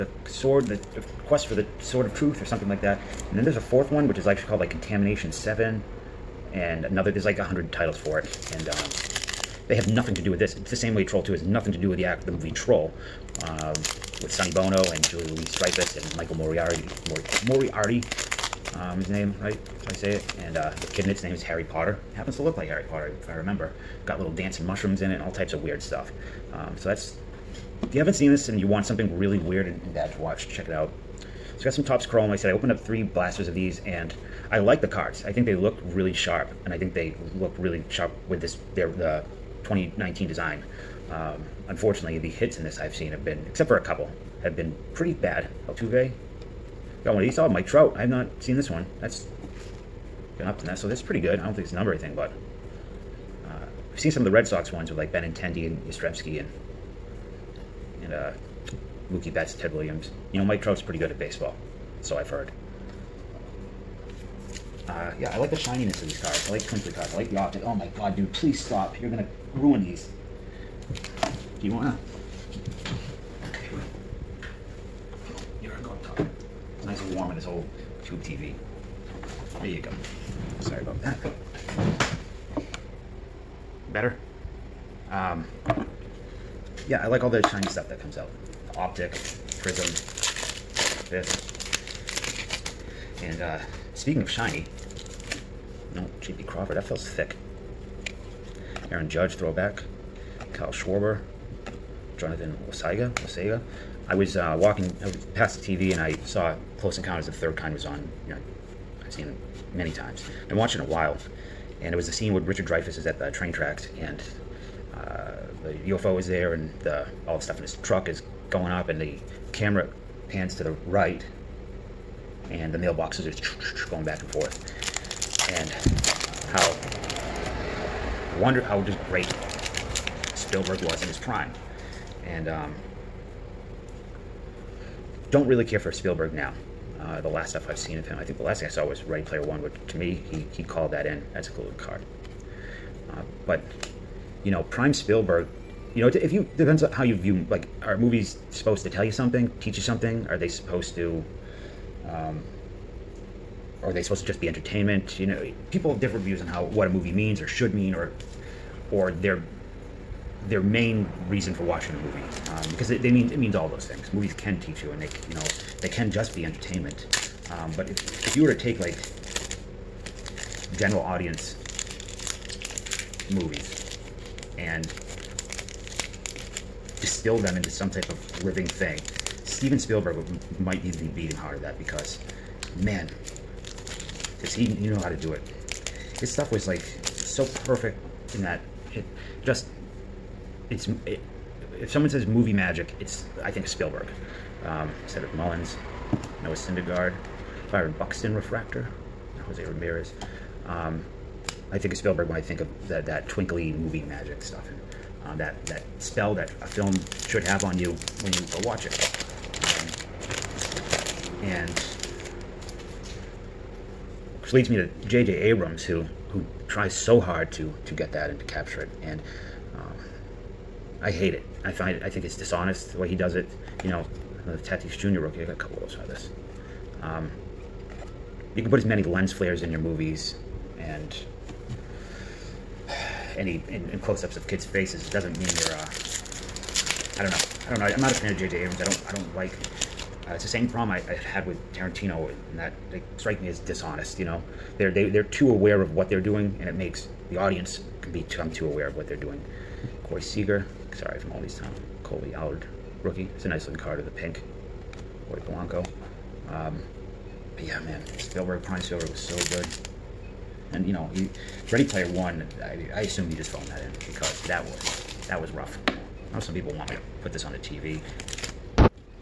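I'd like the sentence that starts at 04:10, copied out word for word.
Corey Seager, sorry from all these town.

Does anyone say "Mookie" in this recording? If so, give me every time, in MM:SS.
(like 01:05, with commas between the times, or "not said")
00:59.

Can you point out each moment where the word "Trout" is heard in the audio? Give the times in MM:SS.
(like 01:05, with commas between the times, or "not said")
00:47, 01:00.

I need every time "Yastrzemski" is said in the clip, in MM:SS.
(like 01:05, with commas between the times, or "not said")
00:55.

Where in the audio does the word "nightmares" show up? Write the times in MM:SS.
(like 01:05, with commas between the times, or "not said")
not said.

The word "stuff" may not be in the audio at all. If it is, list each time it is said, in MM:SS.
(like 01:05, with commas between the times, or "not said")
00:25, 01:27, 01:57, 02:17, 03:06, 03:24.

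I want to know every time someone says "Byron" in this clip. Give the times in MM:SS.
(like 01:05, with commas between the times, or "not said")
03:17.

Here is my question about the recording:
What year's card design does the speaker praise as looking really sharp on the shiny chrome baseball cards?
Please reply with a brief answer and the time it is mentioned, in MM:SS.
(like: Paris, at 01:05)
2019, at 00:39.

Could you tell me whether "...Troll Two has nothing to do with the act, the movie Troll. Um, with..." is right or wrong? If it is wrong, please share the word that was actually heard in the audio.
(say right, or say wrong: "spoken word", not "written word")
right.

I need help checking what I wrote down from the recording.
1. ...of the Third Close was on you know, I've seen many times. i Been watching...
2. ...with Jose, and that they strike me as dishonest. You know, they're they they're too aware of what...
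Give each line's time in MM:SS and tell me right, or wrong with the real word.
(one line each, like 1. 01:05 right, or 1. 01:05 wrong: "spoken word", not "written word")
1. 01:47 wrong: "Kind", not "Close"
2. 04:01 wrong: "Tarantino", not "Jose".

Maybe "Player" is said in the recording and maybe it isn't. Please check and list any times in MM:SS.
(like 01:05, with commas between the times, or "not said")
02:19, 04:21.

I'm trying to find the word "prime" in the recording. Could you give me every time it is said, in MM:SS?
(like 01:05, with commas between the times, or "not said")
02:11, 02:24, 04:18.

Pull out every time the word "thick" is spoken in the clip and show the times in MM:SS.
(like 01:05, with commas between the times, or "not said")
01:37.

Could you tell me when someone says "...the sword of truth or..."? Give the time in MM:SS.
00:01.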